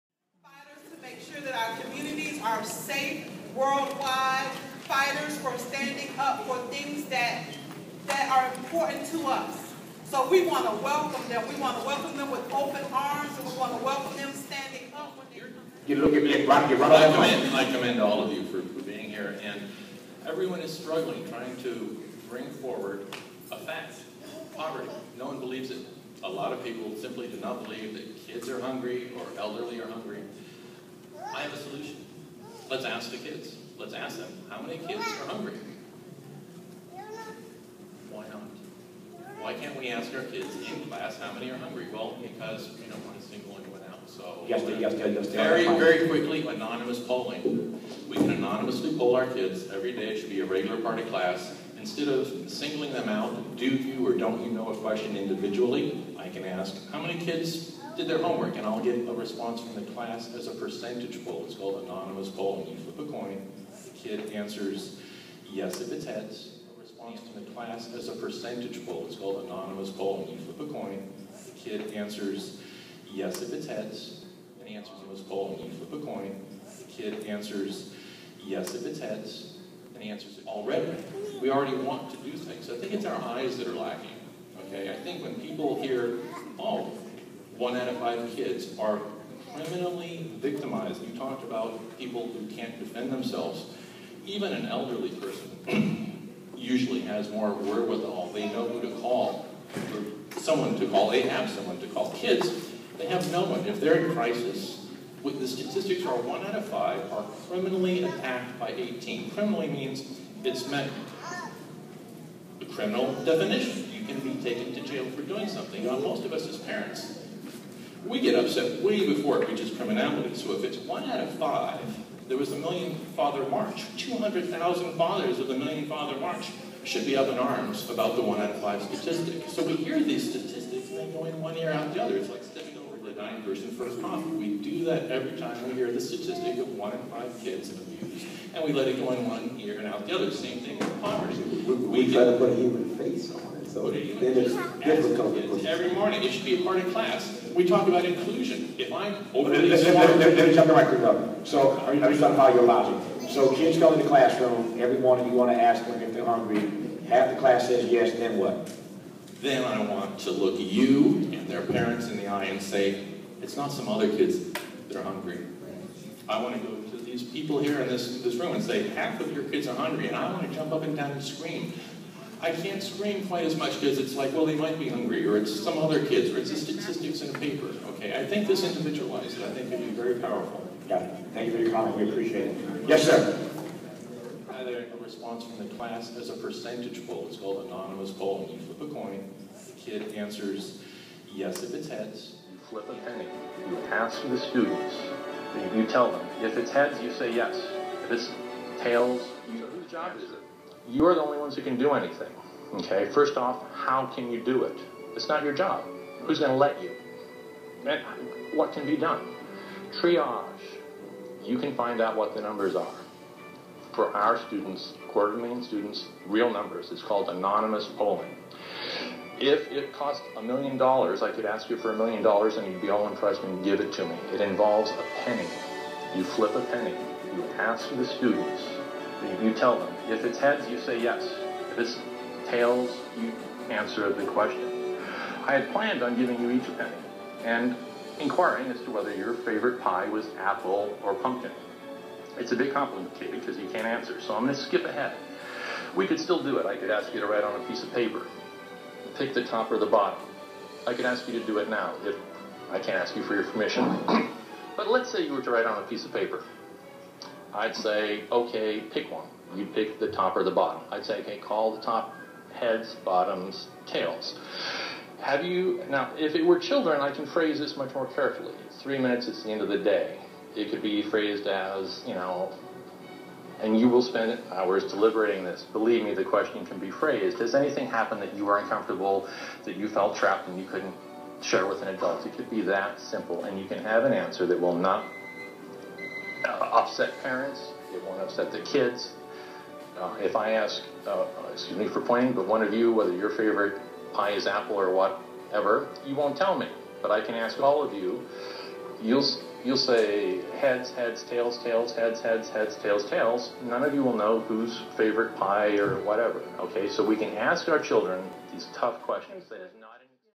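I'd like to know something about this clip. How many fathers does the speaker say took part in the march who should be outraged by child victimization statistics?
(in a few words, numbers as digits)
200,000.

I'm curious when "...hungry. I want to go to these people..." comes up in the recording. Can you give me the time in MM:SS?
02:45.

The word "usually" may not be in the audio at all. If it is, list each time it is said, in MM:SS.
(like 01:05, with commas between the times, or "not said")
01:36.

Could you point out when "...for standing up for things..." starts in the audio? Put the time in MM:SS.
00:05.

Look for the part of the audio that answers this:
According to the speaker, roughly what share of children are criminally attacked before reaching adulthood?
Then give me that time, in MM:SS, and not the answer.
01:46.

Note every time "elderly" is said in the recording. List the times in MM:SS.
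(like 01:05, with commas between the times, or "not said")
00:29, 01:34.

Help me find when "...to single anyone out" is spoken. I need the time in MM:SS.
00:43.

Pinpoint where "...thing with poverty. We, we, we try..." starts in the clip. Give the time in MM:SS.
02:20.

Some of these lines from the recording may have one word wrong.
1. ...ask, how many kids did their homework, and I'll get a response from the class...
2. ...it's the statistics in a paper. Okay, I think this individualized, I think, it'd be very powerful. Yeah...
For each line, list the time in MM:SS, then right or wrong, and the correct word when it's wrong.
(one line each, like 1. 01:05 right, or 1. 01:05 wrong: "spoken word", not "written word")
1. 00:56 right
2. 02:56 right.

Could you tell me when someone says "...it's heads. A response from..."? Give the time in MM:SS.
01:05.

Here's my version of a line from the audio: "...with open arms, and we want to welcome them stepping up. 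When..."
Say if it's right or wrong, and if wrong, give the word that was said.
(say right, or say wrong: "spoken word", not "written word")
wrong: "standing", not "stepping".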